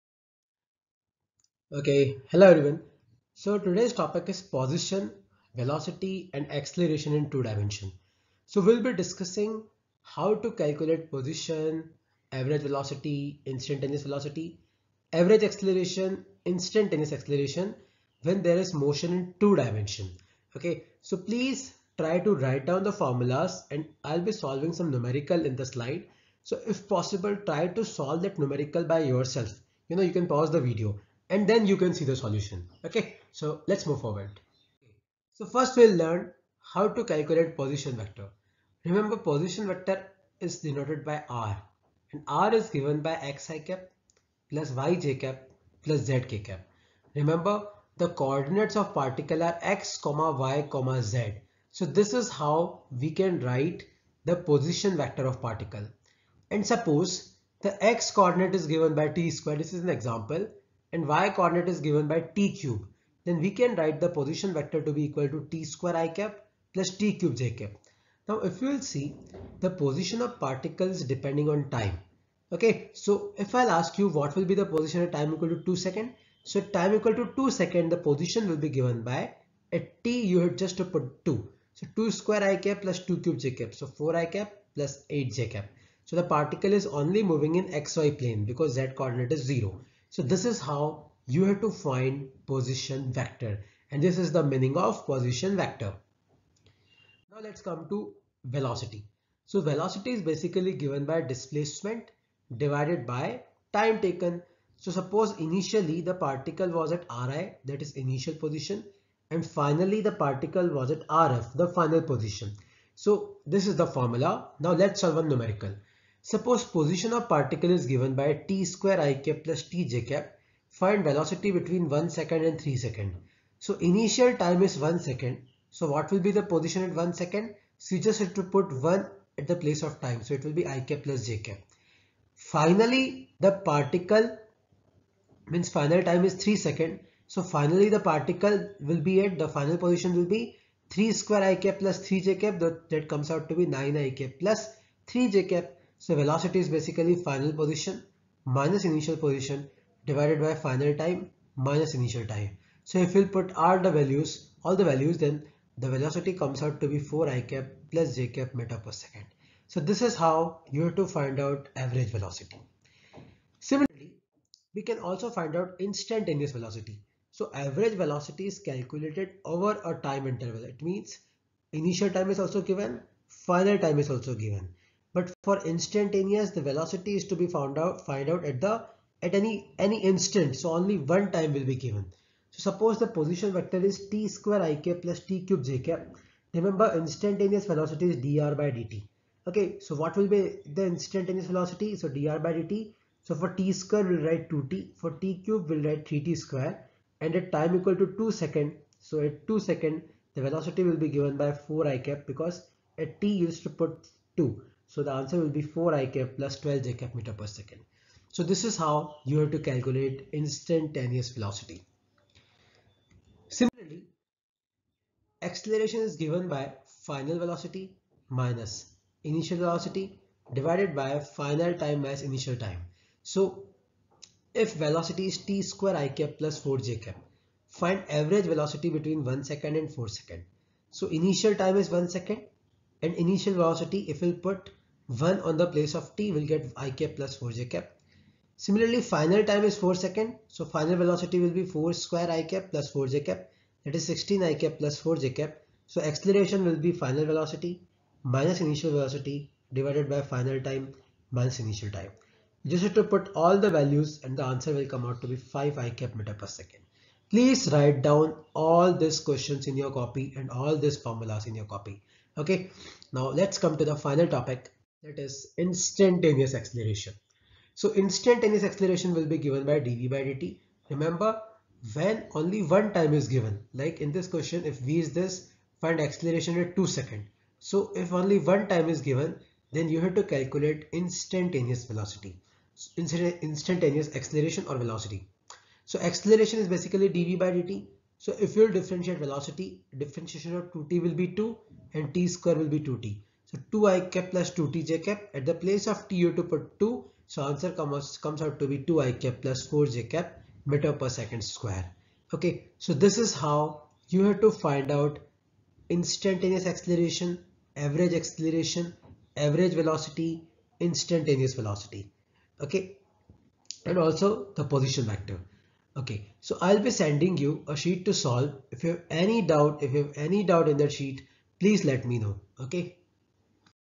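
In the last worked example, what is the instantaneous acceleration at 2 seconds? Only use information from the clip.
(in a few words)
2i + 4j m/s².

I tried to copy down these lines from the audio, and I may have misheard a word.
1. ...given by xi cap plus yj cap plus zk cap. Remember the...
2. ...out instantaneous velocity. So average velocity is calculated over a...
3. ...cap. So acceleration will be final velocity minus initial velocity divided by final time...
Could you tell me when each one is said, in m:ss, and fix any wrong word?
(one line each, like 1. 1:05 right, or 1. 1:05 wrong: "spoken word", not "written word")
1. 0:42 right
2. 2:45 right
3. 4:05 right.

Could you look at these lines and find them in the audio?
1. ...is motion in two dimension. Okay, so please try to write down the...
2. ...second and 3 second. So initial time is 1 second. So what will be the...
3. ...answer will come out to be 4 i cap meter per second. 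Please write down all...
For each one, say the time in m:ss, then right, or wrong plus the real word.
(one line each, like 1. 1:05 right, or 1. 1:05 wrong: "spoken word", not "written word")
1. 0:18 right
2. 2:02 right
3. 4:14 wrong: "5", not "4".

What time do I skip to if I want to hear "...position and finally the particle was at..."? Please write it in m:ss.
1:48.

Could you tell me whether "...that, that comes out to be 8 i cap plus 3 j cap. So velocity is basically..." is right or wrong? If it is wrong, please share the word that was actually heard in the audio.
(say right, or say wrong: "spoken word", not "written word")
wrong: "9", not "8".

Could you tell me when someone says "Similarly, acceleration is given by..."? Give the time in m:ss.
3:33.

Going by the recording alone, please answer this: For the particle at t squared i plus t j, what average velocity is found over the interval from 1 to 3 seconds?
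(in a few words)
4i + j m/s.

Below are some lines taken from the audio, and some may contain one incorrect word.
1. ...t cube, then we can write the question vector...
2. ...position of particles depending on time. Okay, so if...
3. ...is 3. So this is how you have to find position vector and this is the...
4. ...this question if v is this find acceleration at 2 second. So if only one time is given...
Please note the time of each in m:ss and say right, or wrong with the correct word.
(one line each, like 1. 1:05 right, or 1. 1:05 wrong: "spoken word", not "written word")
1. 1:02 wrong: "position", not "question"
2. 1:09 right
3. 1:29 wrong: "0", not "3"
4. 4:34 right.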